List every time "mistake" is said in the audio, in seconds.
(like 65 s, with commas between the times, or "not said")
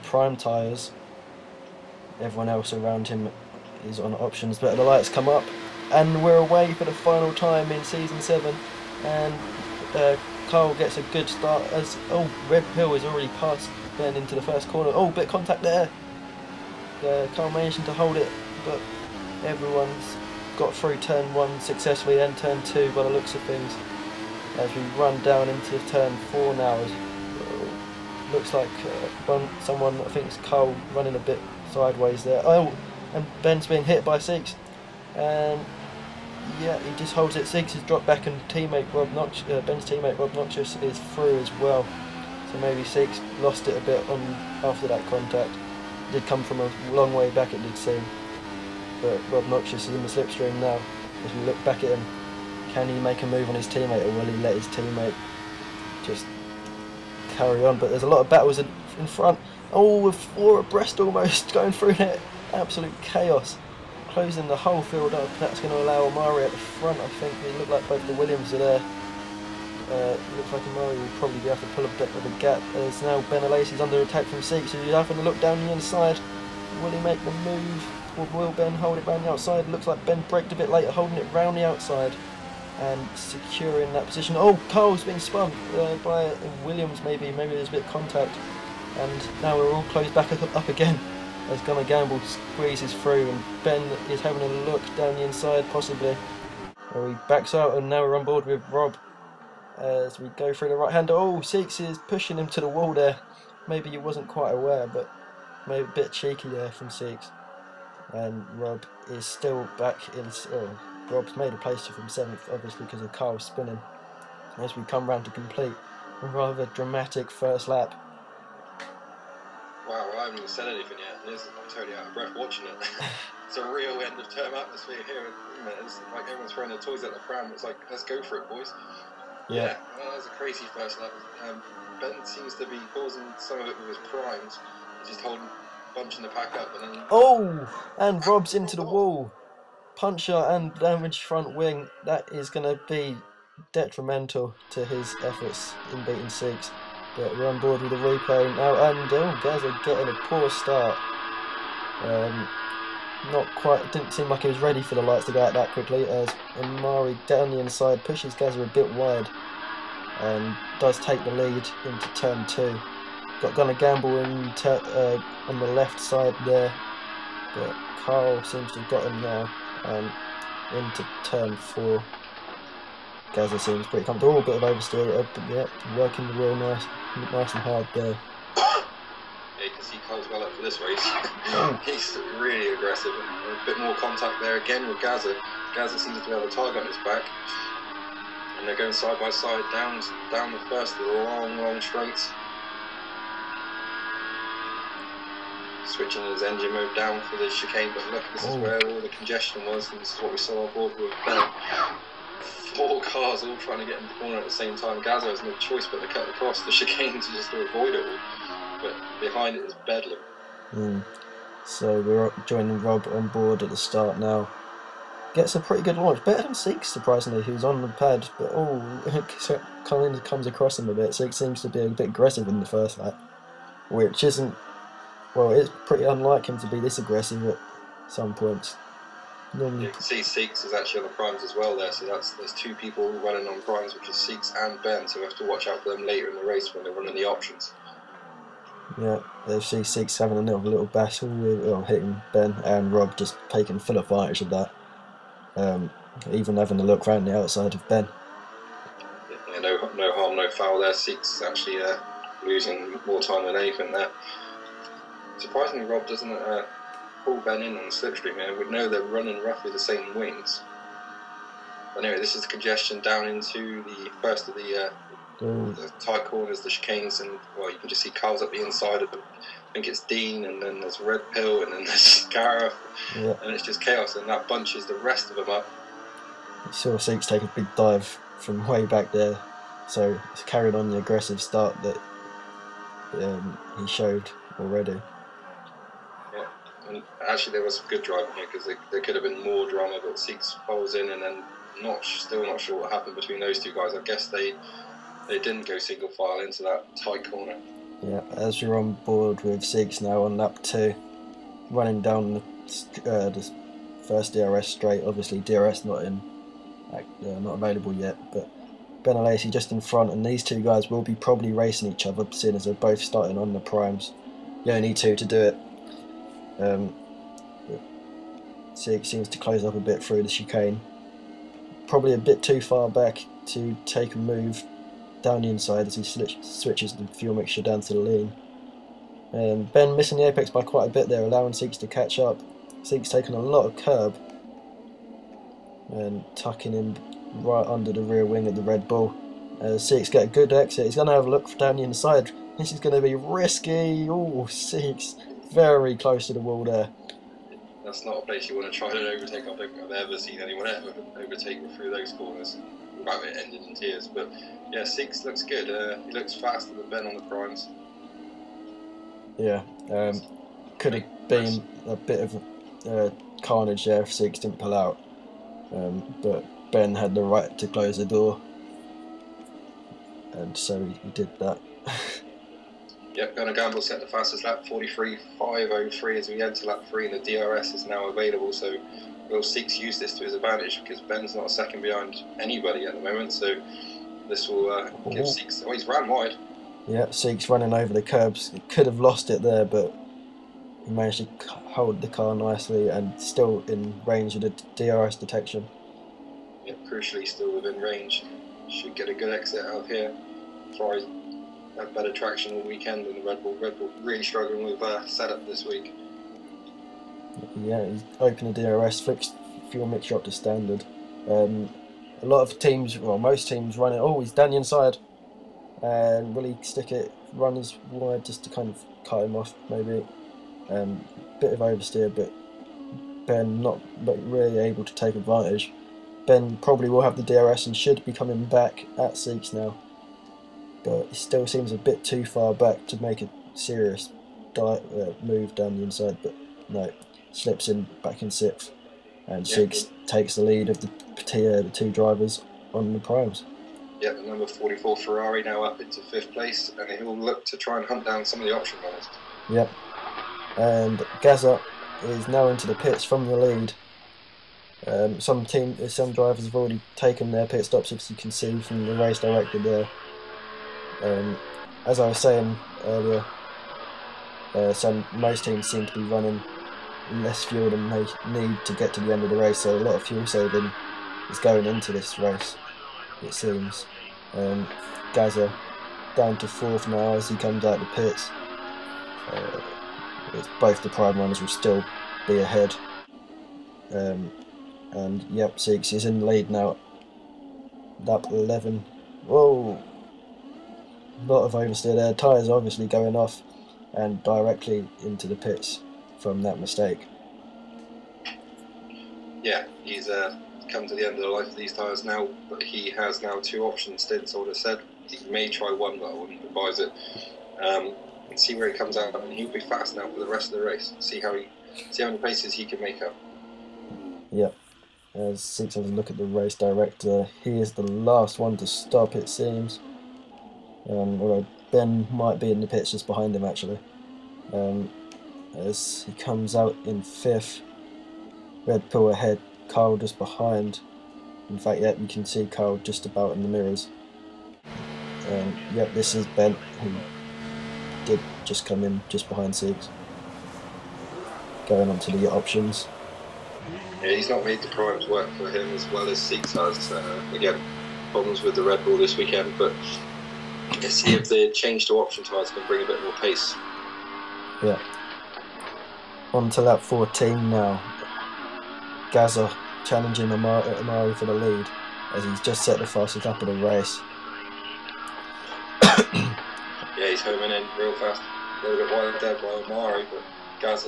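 496 s.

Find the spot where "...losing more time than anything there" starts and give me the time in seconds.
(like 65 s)
252 s.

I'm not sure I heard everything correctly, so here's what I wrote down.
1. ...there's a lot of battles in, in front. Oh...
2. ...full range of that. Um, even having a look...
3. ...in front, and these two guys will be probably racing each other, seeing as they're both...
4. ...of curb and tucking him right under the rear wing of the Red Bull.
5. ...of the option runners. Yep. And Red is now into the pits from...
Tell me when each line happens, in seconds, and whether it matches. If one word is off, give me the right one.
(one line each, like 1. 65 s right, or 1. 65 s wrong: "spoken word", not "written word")
1. 57 s right
2. 243 s wrong: "advantage", not "range"
3. 309 s right
4. 333 s right
5. 448 s wrong: "Gazza", not "Red".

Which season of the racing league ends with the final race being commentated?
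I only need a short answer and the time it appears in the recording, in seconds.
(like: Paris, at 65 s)
7, at 7 s.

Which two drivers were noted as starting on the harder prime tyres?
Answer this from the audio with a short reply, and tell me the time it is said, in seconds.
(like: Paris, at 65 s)
Seeks and Ben, at 234 s.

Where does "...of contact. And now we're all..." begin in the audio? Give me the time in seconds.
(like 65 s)
87 s.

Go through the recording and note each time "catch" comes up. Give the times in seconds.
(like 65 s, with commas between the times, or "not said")
331 s.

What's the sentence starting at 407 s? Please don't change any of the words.
Yeah, he's opened the DRS, fixed fuel mixture up to standard.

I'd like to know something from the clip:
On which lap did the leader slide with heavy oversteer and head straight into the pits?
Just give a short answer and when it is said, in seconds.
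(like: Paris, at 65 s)
11, at 488 s.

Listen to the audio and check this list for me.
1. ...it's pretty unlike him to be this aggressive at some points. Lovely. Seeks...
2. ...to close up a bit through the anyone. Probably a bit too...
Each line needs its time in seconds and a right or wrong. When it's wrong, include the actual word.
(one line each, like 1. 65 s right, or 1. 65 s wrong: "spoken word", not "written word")
1. 225 s right
2. 319 s wrong: "chicane", not "anyone".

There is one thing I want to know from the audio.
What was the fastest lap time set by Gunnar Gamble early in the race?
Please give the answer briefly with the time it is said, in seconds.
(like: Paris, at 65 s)
43.503, at 374 s.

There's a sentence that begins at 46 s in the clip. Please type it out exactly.
It did come from a long way back, it did seem.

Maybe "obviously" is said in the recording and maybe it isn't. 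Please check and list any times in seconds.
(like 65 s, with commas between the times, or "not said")
112 s, 305 s, 492 s.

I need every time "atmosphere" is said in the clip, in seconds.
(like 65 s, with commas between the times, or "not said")
124 s.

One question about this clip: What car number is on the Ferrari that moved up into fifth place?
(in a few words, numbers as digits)
44.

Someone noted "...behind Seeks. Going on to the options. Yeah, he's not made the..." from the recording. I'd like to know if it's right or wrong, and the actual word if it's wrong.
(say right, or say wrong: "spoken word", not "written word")
right.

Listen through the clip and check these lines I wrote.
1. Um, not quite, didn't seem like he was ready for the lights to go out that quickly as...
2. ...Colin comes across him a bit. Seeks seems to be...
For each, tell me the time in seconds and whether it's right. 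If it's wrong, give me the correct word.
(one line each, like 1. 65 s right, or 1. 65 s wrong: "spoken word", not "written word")
1. 152 s right
2. 219 s right.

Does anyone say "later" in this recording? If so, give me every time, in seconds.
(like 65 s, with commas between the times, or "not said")
80 s, 236 s.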